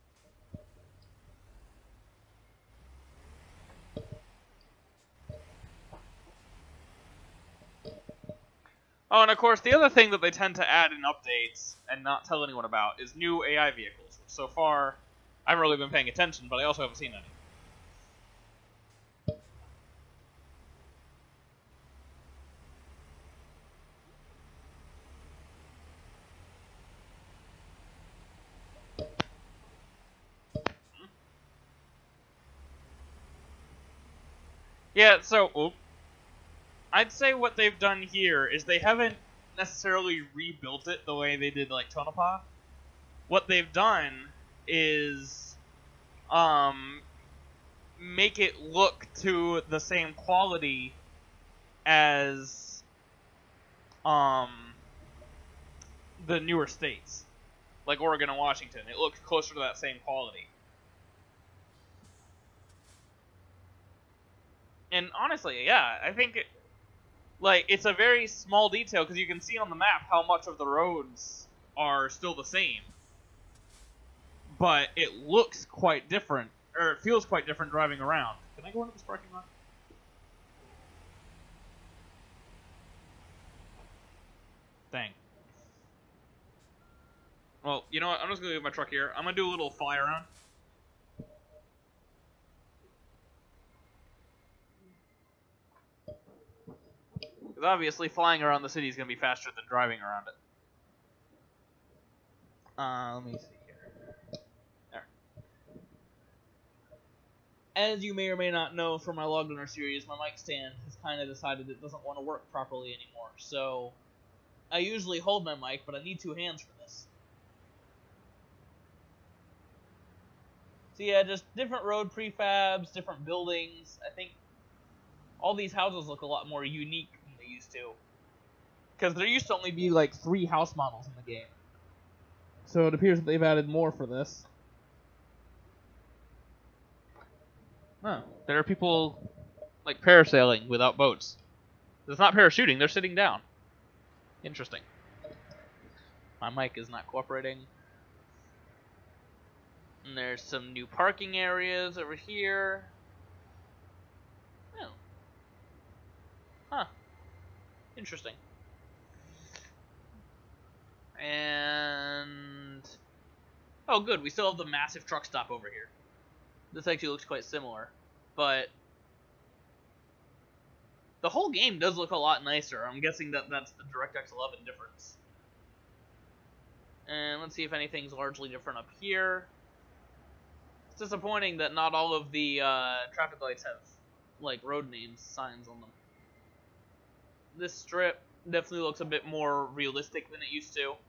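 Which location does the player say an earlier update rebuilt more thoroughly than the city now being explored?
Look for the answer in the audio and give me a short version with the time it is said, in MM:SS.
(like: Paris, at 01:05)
Tonopah, at 00:41.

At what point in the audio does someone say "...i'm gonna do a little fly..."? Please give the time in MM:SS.
01:29.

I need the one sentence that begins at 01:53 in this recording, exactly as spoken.
So I usually hold my mic, but I need two hands for this.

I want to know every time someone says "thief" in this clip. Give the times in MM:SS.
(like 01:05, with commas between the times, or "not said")
not said.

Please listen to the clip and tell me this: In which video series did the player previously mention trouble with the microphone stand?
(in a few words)
Logliner.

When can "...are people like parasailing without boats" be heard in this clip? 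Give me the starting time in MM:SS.
02:18.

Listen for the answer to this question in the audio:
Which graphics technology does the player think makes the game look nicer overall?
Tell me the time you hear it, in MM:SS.
02:53.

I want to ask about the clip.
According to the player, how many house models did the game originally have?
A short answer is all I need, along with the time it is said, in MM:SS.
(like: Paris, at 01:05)
3, at 02:10.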